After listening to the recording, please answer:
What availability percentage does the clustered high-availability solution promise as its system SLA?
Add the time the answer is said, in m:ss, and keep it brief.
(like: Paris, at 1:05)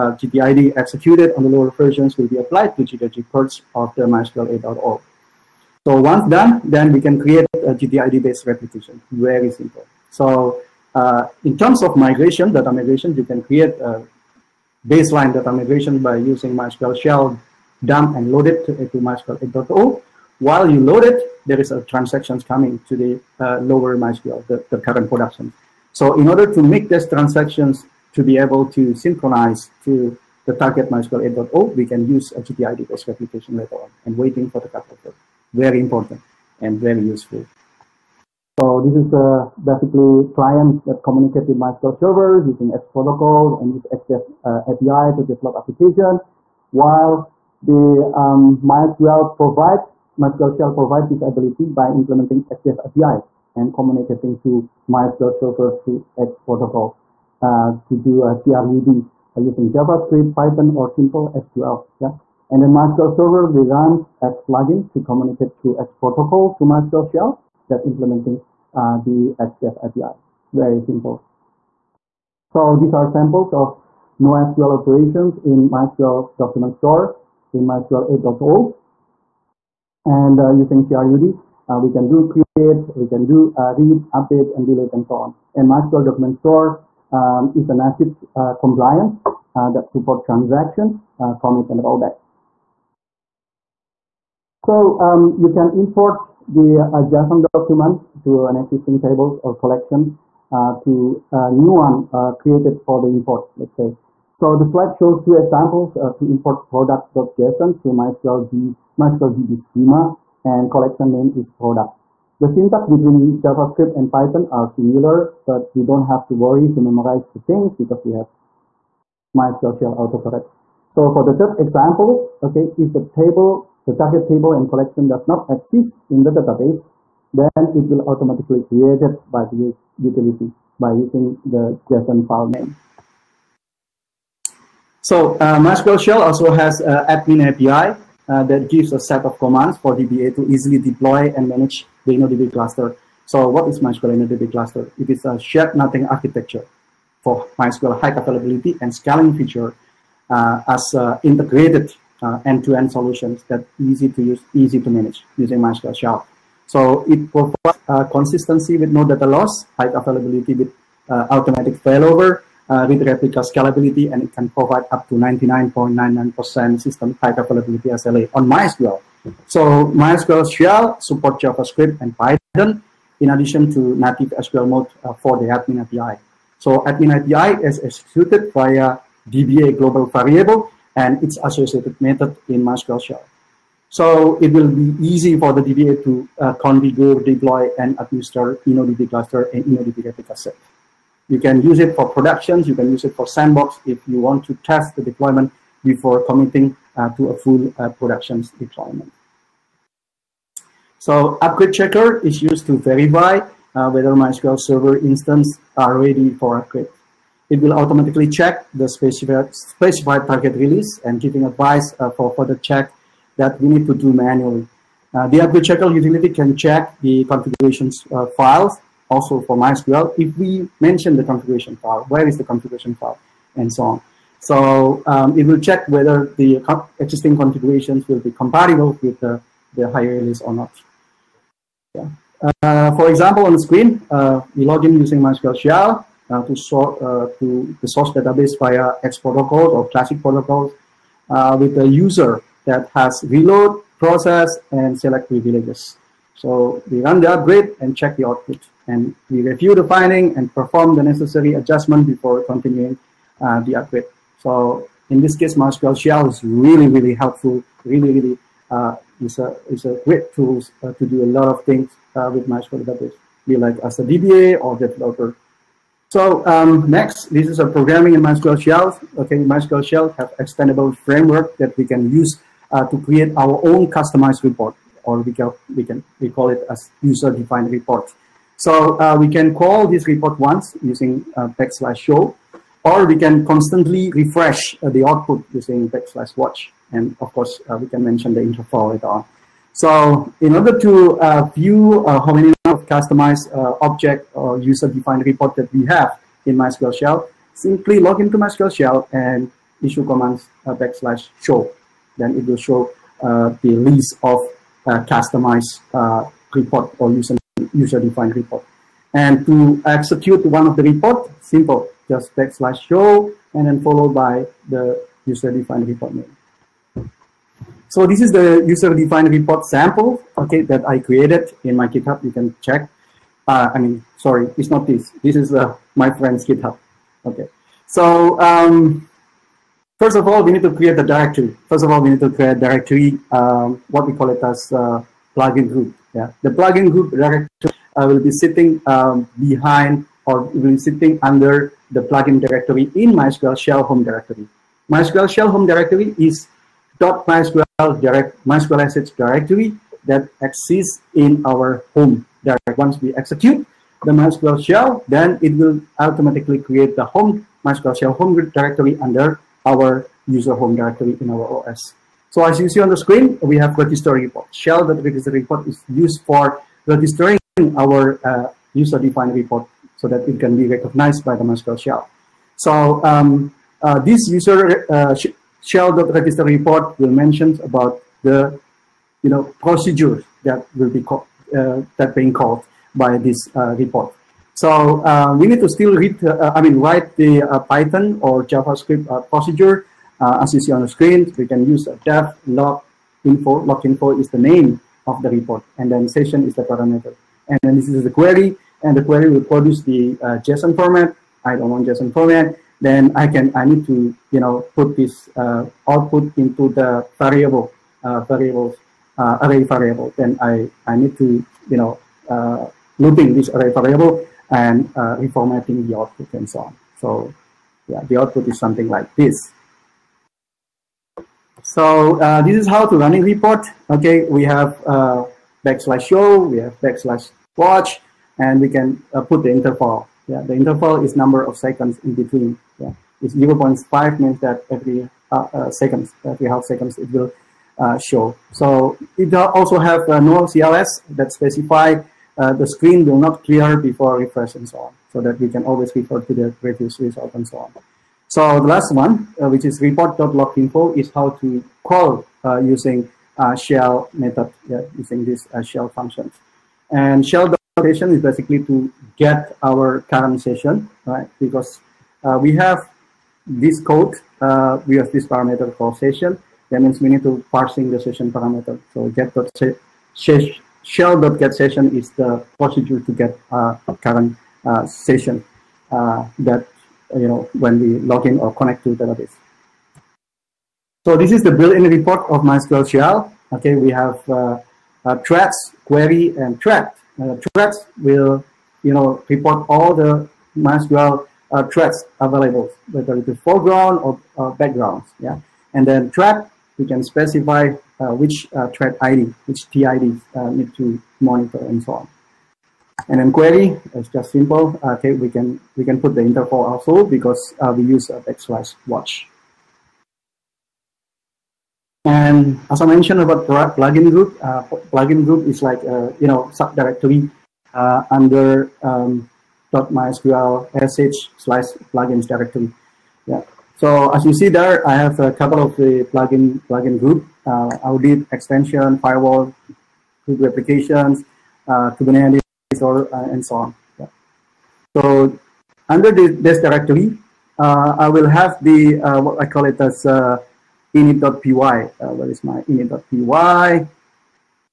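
99.99%, at 2:45.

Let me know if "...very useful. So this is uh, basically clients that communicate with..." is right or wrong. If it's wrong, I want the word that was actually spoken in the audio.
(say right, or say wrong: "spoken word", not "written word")
right.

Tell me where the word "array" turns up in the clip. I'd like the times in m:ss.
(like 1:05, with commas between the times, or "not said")
6:49, 6:53.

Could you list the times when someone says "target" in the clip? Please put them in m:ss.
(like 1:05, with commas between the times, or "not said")
0:30, 2:03, 3:30.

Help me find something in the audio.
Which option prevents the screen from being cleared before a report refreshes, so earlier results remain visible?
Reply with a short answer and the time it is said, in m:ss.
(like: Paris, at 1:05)
no CLS, at 7:20.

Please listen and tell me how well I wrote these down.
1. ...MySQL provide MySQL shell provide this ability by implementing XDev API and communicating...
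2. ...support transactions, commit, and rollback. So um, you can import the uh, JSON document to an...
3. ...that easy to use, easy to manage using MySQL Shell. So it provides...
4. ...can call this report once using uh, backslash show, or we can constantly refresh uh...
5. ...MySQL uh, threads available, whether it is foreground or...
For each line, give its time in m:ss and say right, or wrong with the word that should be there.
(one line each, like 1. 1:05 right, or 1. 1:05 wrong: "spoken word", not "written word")
1. 0:48 right
2. 1:29 right
3. 2:33 right
4. 4:39 right
5. 8:10 right.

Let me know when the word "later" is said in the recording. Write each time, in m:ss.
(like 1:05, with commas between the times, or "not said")
0:33, 4:48.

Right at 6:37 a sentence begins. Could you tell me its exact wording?
And then this is the query, and the query will produce the JSON format.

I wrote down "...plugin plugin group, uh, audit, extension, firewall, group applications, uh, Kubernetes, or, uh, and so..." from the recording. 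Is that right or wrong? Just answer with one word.
right.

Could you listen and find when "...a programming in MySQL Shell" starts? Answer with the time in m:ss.
4:27.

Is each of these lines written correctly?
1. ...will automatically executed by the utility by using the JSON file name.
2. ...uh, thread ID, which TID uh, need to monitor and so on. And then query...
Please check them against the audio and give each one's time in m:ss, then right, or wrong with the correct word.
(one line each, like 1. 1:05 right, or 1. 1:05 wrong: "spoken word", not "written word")
1. 2:07 wrong: "created", not "executed"
2. 8:18 right.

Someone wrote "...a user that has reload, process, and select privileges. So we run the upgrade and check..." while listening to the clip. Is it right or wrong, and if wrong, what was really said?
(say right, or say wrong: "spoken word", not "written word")
right.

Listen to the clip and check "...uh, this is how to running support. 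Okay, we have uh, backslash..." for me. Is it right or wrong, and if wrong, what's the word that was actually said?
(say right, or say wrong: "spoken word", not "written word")
wrong: "report", not "support".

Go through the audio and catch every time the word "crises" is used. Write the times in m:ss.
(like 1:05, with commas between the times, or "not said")
not said.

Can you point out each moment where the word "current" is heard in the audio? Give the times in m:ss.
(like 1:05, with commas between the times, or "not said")
0:24, 7:40, 7:54.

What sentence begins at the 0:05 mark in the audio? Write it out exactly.
So once done, then we can create a GTID-based replication, very simple.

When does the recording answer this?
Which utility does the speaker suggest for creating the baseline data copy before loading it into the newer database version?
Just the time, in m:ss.
0:16.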